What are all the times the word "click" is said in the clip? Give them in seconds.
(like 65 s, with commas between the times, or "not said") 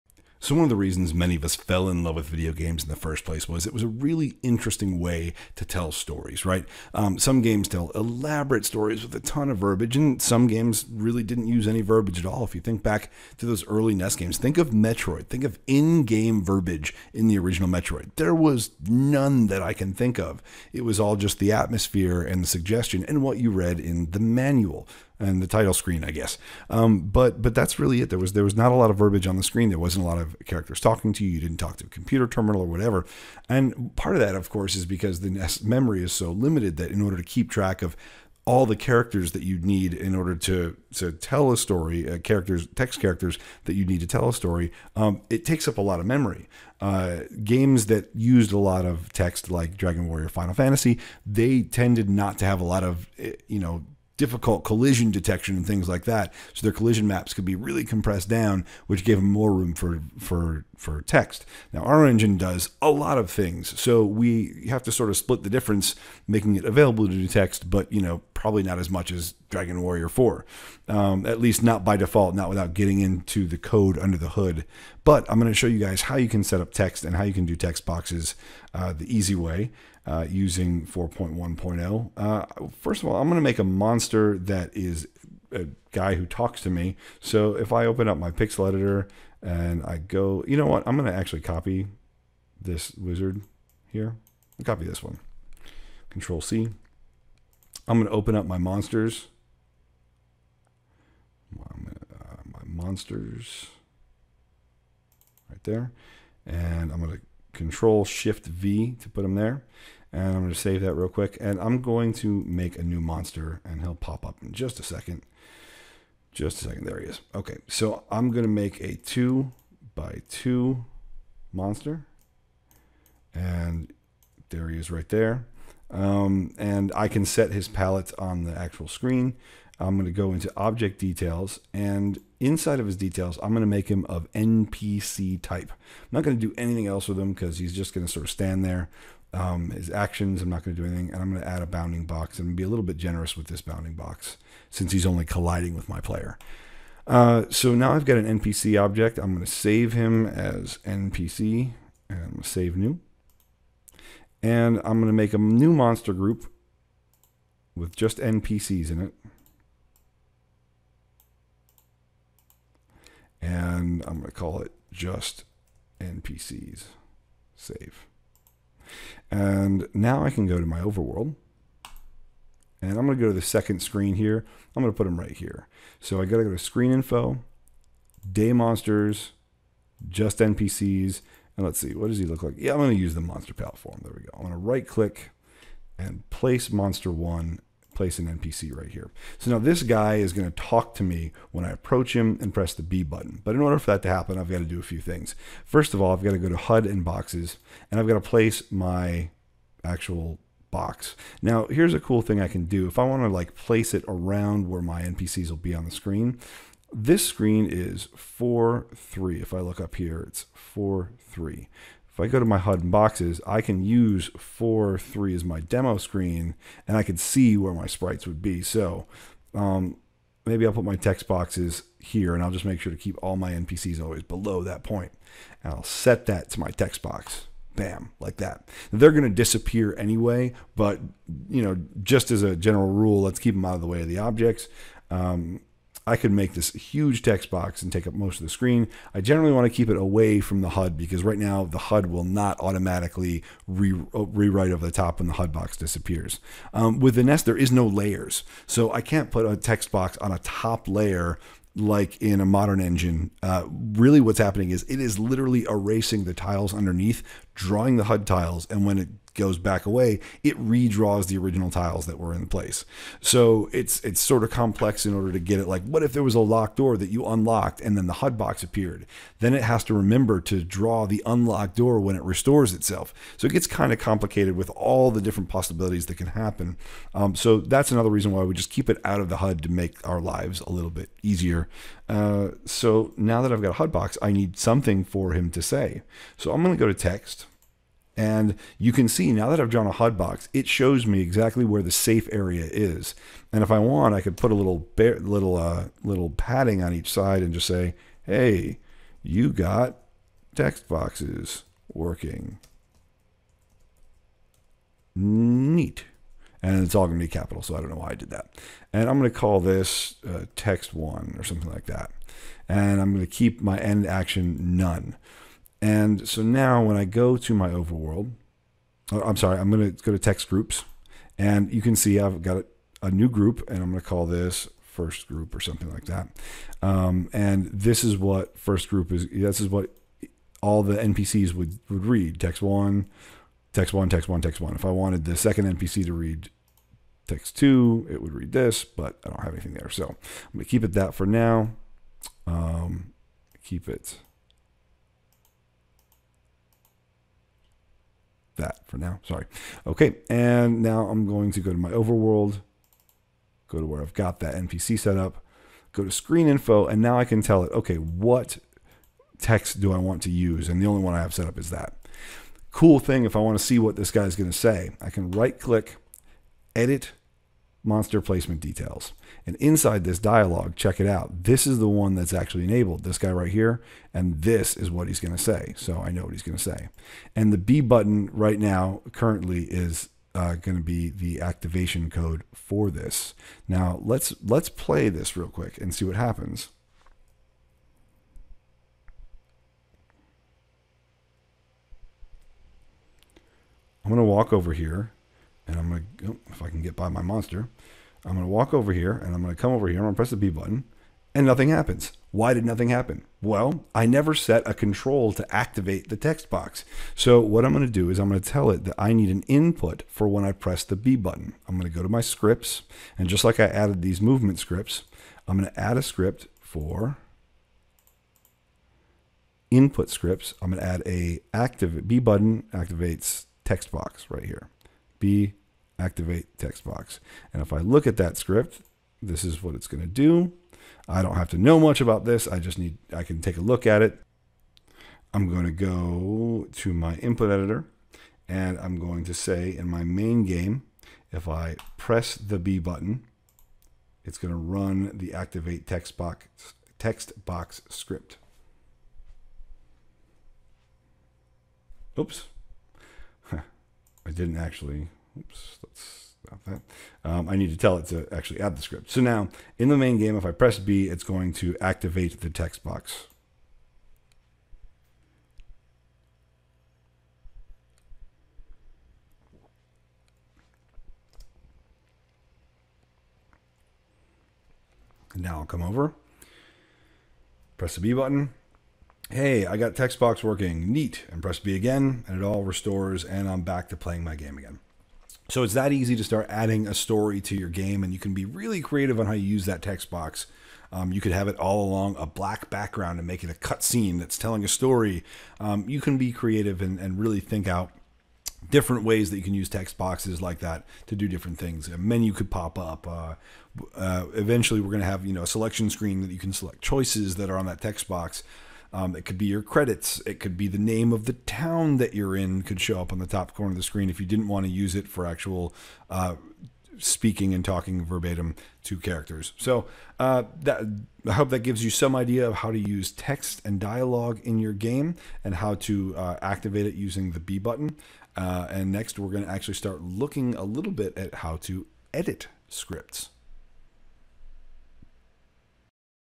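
184 s, 365 s.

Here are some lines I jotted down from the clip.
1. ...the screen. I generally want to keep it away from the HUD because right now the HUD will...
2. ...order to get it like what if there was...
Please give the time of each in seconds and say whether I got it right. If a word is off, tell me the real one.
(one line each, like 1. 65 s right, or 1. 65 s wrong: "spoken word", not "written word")
1. 238 s right
2. 265 s right.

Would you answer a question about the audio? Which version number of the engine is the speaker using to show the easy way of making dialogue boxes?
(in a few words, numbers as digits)
4.1.0.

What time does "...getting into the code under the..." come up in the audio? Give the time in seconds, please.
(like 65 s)
72 s.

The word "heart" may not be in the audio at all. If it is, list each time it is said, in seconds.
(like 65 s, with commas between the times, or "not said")
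not said.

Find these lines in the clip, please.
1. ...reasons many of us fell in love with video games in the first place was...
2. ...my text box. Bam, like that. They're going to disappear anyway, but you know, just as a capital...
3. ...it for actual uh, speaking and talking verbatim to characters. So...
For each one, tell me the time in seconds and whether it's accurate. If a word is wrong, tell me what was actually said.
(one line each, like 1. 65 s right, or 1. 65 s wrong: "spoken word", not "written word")
1. 0 s right
2. 226 s wrong: "general", not "capital"
3. 514 s right.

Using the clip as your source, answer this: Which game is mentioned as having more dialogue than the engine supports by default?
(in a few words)
Dragon Warrior 4.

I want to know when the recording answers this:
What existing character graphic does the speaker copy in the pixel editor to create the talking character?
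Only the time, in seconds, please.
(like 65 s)
92 s.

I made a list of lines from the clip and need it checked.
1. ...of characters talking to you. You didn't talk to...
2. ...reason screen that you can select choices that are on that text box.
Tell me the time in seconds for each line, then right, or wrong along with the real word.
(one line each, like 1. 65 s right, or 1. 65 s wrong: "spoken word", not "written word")
1. 30 s right
2. 505 s wrong: "selection", not "reason".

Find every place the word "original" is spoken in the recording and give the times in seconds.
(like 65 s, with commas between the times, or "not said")
17 s, 261 s.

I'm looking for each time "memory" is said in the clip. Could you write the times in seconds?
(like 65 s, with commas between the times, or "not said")
35 s, 46 s.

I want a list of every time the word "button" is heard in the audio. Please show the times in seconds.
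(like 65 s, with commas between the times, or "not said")
193 s, 377 s, 400 s, 411 s, 422 s, 442 s, 478 s, 527 s.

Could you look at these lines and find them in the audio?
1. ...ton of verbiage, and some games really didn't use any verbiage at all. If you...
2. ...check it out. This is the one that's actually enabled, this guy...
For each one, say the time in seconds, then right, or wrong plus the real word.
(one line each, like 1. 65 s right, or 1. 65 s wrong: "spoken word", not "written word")
1. 9 s right
2. 370 s right.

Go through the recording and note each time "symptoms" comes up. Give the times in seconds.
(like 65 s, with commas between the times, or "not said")
not said.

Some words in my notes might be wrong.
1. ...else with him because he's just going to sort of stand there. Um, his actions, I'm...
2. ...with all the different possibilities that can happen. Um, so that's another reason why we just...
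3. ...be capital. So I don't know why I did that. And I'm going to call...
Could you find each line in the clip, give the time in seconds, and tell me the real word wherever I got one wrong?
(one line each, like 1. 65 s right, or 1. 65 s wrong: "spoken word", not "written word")
1. 136 s right
2. 274 s right
3. 307 s right.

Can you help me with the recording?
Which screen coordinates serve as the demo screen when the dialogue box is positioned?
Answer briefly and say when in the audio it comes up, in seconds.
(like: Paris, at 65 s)
4, 3, at 214 s.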